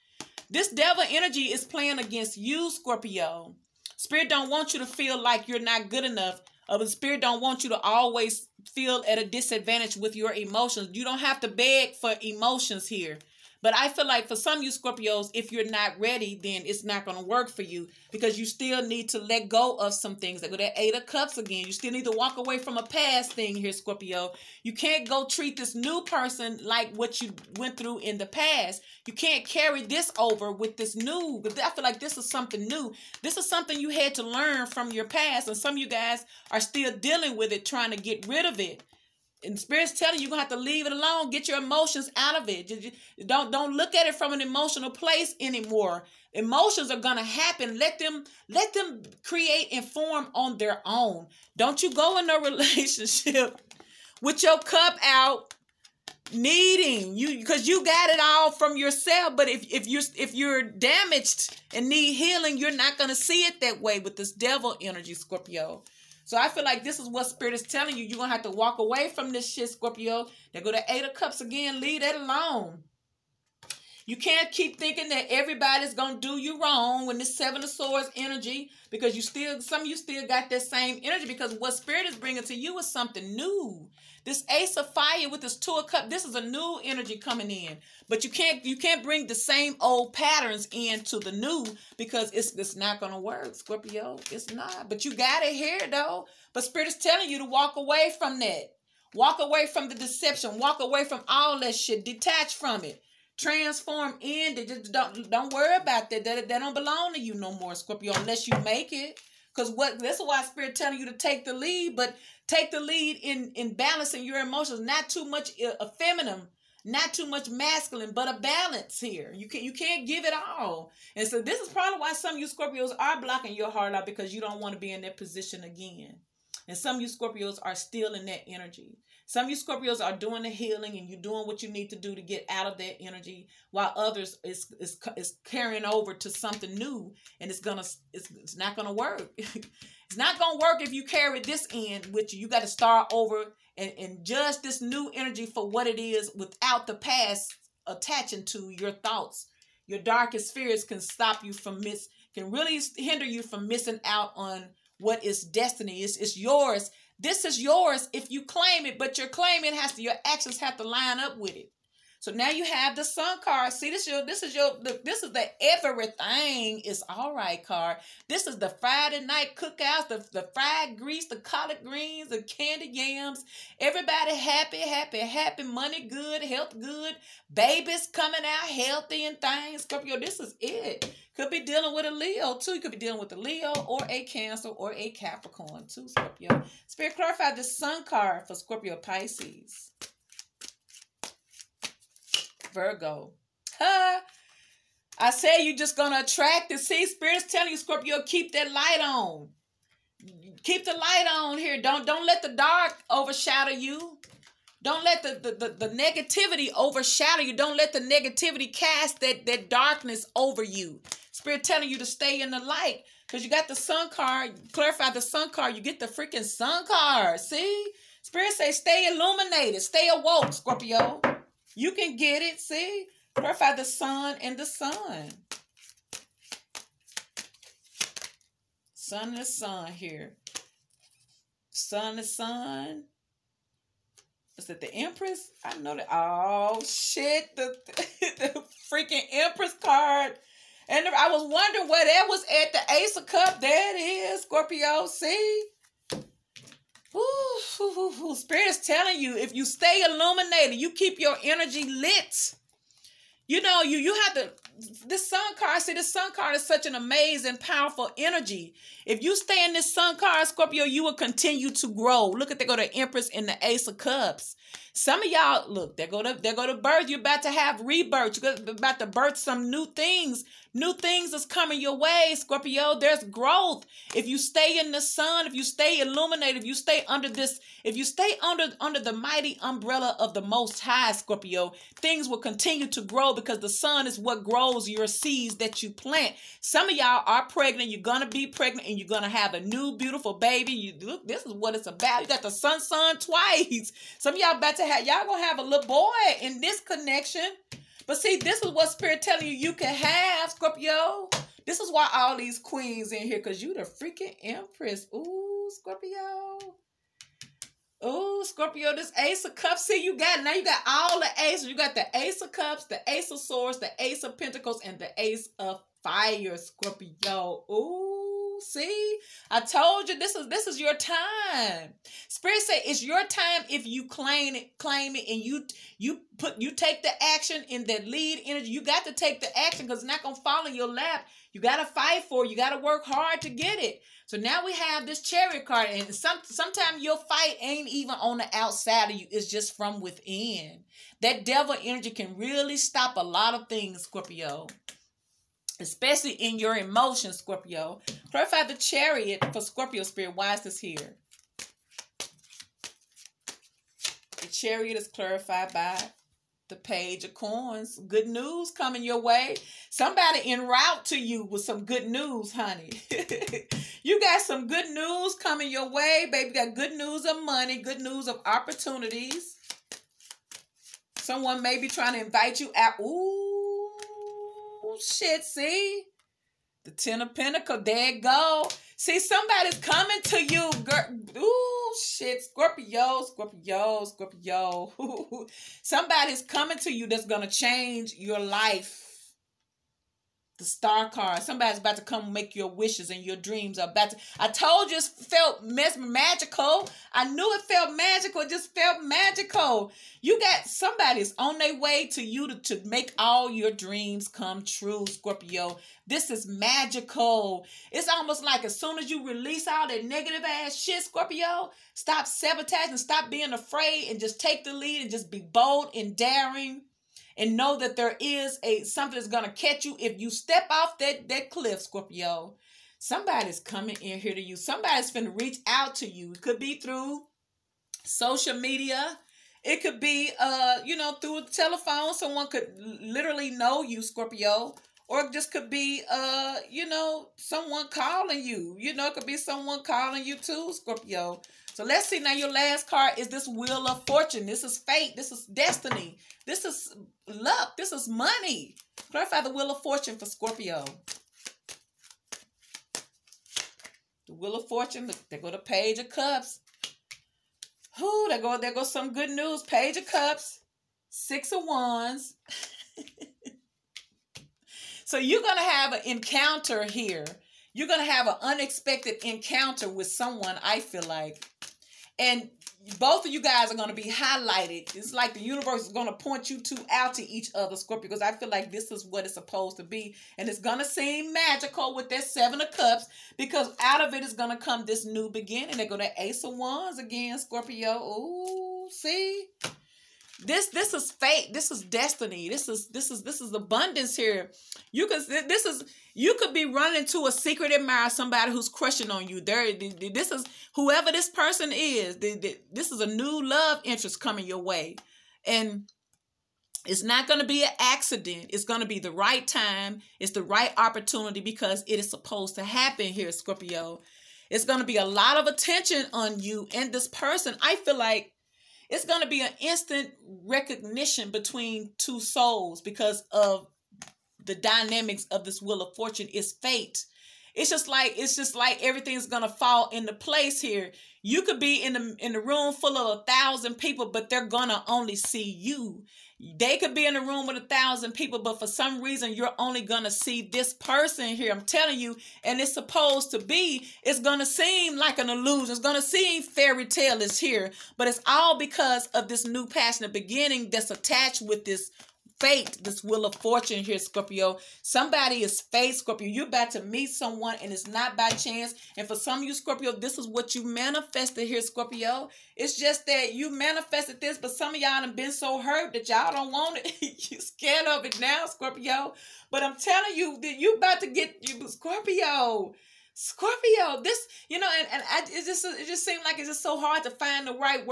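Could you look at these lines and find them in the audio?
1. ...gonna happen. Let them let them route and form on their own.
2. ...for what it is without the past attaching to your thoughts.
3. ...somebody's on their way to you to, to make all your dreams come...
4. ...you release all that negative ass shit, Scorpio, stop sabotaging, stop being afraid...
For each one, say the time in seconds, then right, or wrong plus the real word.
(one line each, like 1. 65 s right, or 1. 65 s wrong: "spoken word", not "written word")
1. 46 s wrong: "create", not "route"
2. 145 s right
3. 400 s right
4. 409 s right.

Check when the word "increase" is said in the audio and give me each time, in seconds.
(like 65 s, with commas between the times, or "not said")
not said.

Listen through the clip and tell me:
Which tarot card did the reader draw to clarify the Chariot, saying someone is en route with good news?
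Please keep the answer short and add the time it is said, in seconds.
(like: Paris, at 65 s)
Page of Coins, at 356 s.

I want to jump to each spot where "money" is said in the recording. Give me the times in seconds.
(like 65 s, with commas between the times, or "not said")
175 s, 367 s, 448 s.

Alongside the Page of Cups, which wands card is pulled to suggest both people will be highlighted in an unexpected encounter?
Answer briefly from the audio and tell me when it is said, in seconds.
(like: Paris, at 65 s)
Six of Wands, at 461 s.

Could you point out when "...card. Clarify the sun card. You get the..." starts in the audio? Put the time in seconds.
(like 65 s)
214 s.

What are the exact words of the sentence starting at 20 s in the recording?
Like with that Eight of Cups again, you still need to walk away from a past thing here, Scorpio.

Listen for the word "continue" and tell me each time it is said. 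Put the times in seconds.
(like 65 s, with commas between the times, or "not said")
261 s, 282 s.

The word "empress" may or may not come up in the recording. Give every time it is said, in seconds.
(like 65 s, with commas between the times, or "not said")
234 s, 239 s, 262 s, 304 s.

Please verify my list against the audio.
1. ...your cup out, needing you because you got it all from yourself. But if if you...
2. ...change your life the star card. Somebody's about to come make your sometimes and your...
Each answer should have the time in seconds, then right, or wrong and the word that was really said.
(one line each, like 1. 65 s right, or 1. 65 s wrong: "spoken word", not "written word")
1. 54 s right
2. 387 s wrong: "wishes", not "sometimes".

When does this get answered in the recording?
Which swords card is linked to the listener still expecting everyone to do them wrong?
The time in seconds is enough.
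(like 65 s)
77 s.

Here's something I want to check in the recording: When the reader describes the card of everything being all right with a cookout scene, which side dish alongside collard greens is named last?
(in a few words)
candy yams.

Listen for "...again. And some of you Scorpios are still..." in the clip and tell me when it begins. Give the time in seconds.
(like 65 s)
125 s.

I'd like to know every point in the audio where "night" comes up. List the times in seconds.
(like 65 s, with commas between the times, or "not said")
169 s.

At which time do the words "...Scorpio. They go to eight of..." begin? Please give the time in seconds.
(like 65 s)
69 s.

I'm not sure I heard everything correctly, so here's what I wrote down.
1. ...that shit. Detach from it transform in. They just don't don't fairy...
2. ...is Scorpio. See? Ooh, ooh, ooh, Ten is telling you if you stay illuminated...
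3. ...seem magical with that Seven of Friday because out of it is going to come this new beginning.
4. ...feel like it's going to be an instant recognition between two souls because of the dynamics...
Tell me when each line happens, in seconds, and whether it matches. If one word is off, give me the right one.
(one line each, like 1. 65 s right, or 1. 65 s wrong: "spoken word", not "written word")
1. 101 s wrong: "worry", not "fairy"
2. 243 s wrong: "Spirit", not "Ten"
3. 480 s wrong: "Cups", not "Friday"
4. 517 s right.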